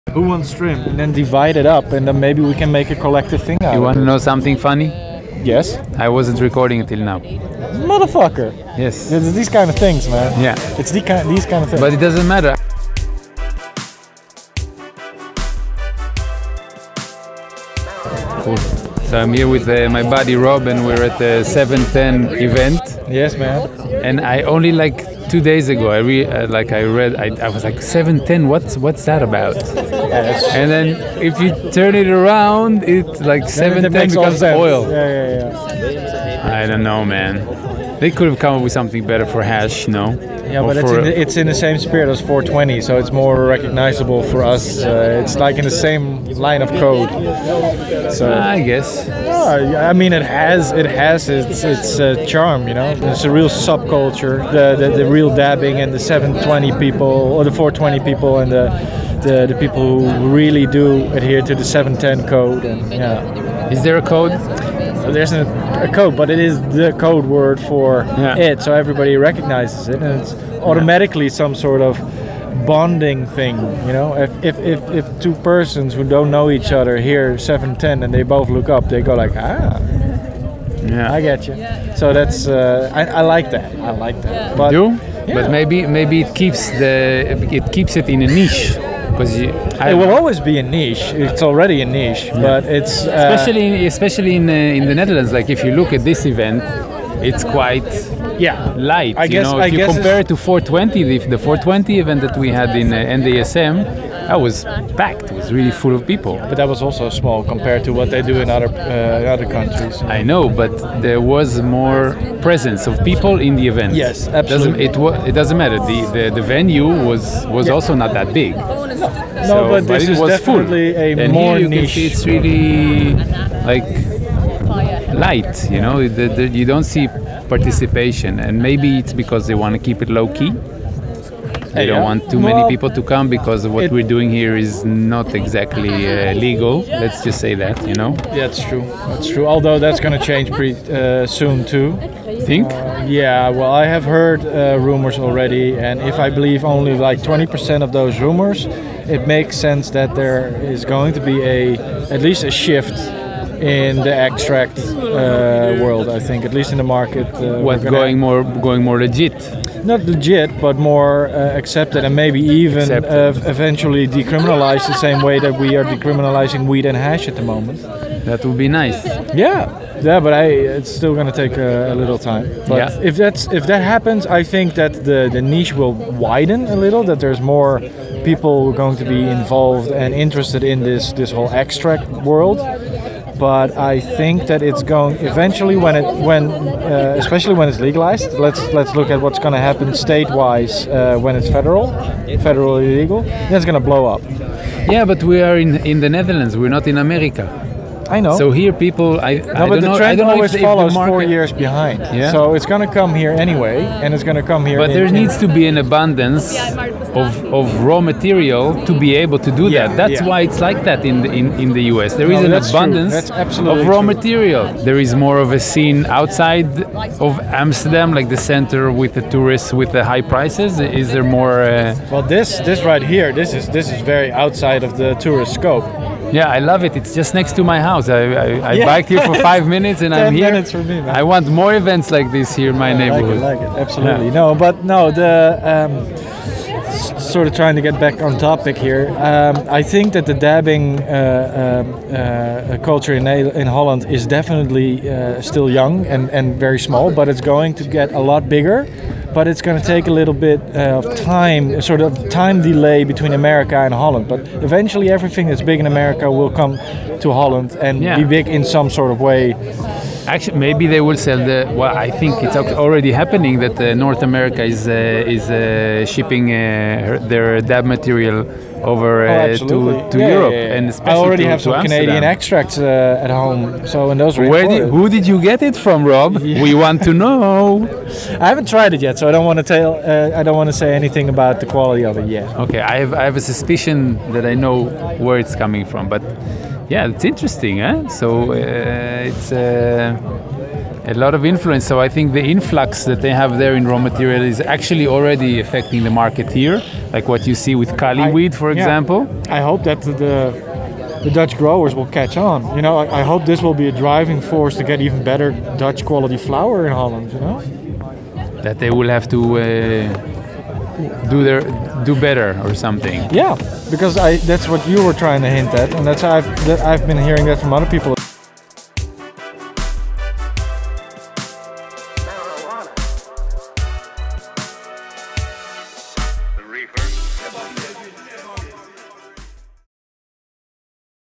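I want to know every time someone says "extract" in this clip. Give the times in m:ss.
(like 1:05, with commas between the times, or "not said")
2:34, 3:01, 4:32.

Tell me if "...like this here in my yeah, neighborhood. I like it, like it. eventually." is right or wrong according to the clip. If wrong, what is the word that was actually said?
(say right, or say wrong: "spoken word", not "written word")
wrong: "absolutely", not "eventually".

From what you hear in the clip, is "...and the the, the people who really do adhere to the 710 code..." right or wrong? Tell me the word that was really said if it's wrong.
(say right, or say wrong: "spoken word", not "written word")
right.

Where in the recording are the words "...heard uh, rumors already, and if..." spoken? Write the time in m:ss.
2:24.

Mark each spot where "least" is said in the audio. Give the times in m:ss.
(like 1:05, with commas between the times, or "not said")
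2:32, 2:36.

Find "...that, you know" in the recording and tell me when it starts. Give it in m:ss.
2:17.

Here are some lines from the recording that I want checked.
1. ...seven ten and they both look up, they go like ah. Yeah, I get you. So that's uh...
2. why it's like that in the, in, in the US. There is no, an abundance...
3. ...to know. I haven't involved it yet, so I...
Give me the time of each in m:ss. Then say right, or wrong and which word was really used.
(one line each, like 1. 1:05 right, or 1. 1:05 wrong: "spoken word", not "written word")
1. 1:17 right
2. 3:30 right
3. 4:37 wrong: "tried", not "involved".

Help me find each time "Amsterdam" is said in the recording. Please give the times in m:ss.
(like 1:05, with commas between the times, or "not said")
3:37, 4:31.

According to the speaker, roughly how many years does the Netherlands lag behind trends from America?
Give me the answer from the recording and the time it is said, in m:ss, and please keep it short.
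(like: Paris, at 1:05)
4, at 3:20.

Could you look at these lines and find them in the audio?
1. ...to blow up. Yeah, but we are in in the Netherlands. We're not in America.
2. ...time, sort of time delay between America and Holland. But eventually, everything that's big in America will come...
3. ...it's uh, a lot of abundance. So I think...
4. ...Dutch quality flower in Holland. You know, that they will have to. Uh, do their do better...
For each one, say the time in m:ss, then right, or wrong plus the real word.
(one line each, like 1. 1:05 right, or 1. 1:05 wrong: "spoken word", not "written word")
1. 3:13 right
2. 4:11 right
3. 4:49 wrong: "influence", not "abundance"
4. 5:05 right.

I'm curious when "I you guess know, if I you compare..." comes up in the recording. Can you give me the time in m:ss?
1:39.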